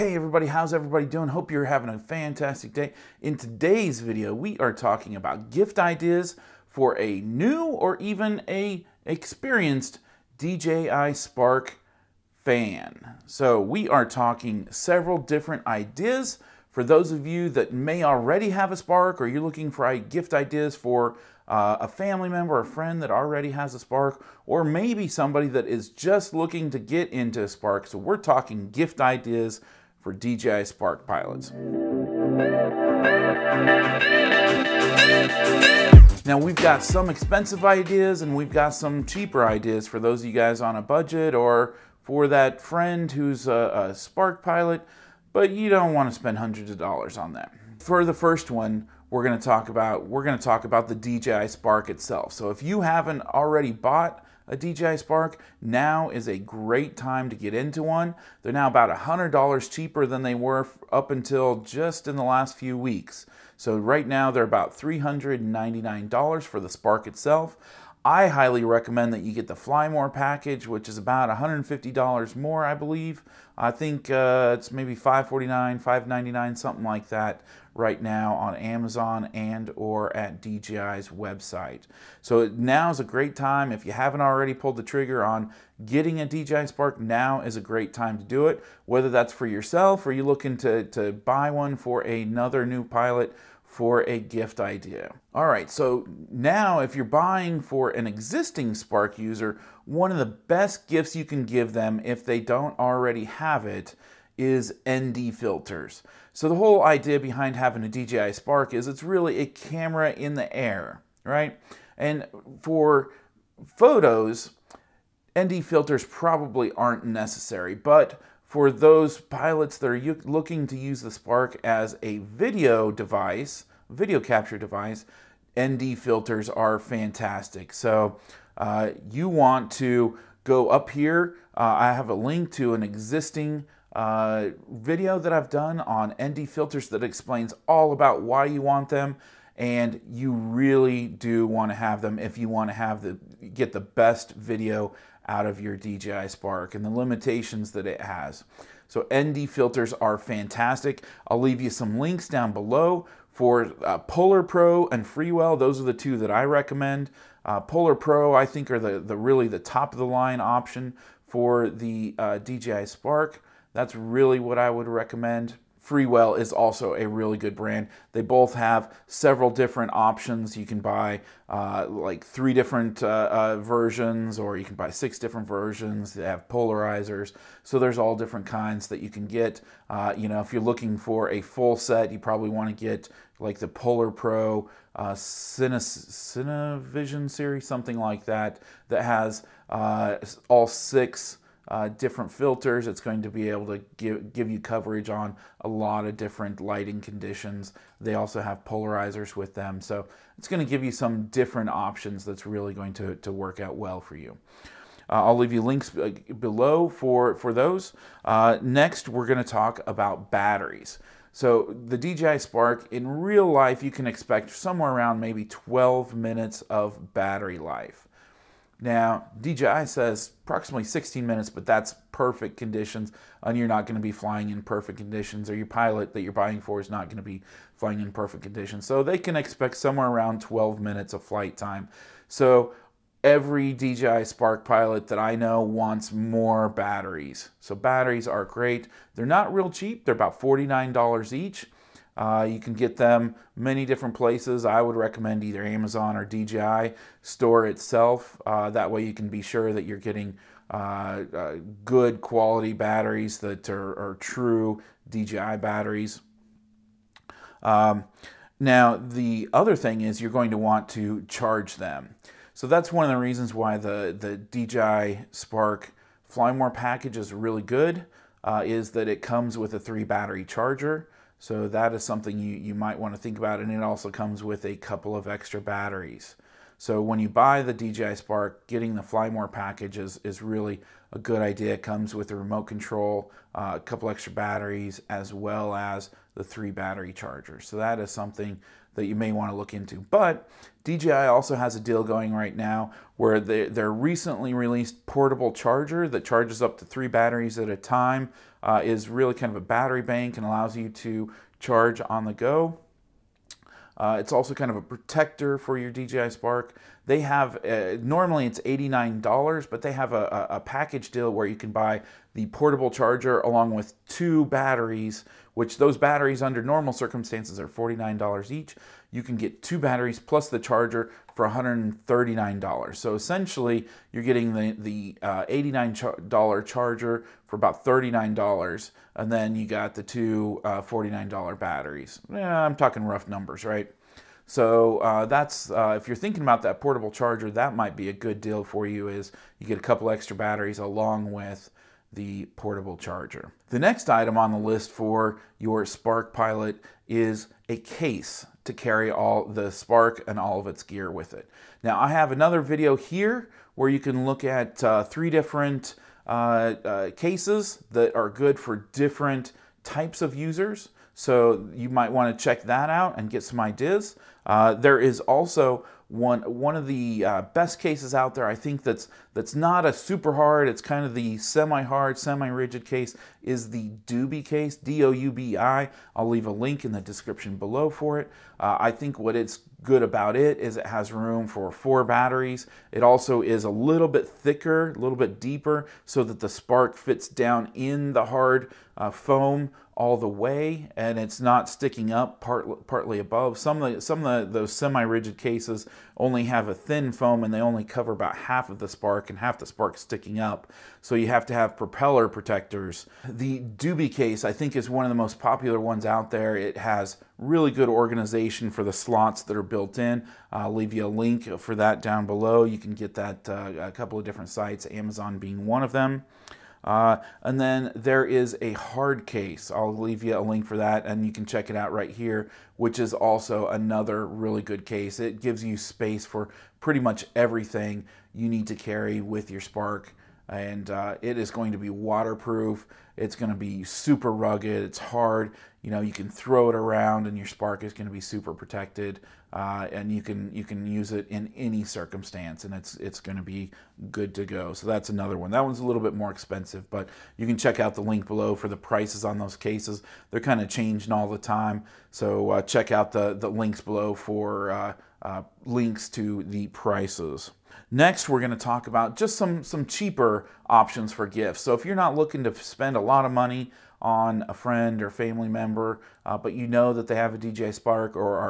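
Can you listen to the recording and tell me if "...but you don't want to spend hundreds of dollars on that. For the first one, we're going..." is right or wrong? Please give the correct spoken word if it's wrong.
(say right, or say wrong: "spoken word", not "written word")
right.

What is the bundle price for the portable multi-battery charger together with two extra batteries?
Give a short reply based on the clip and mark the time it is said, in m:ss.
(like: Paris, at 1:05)
$139, at 5:21.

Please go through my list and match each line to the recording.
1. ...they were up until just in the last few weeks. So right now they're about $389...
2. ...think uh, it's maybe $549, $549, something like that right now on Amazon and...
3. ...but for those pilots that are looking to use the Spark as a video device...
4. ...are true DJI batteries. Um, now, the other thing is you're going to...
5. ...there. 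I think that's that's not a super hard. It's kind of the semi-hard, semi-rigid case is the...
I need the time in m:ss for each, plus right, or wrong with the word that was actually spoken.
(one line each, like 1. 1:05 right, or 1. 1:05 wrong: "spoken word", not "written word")
1. 1:00 wrong: "399", not "389"
2. 1:13 wrong: "599", not "549"
3. 1:57 right
4. 4:13 right
5. 6:08 right.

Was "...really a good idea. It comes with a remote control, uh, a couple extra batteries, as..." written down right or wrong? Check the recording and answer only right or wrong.
right.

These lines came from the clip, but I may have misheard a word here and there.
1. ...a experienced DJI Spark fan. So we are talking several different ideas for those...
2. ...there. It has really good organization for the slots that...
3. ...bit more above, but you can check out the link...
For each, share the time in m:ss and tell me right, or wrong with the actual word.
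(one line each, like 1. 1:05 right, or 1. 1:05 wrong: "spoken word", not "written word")
1. 0:08 right
2. 6:46 right
3. 7:26 wrong: "expensive", not "above".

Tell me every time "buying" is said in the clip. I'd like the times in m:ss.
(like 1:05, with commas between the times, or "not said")
1:37, 3:46.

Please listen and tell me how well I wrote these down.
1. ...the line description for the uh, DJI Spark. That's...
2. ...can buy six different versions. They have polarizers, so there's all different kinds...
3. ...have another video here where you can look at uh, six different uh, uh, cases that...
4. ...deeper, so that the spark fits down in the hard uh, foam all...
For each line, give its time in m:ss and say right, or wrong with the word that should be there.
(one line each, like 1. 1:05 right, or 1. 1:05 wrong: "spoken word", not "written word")
1. 2:39 wrong: "option", not "description"
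2. 2:54 right
3. 5:52 wrong: "three", not "six"
4. 6:25 right.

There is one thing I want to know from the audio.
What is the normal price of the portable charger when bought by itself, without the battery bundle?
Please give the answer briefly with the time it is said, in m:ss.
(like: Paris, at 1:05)
$89, at 5:08.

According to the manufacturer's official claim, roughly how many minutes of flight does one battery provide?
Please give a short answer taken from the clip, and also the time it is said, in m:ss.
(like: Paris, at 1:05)
16 minutes, at 3:40.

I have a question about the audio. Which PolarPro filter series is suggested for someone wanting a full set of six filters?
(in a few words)
Cinevision.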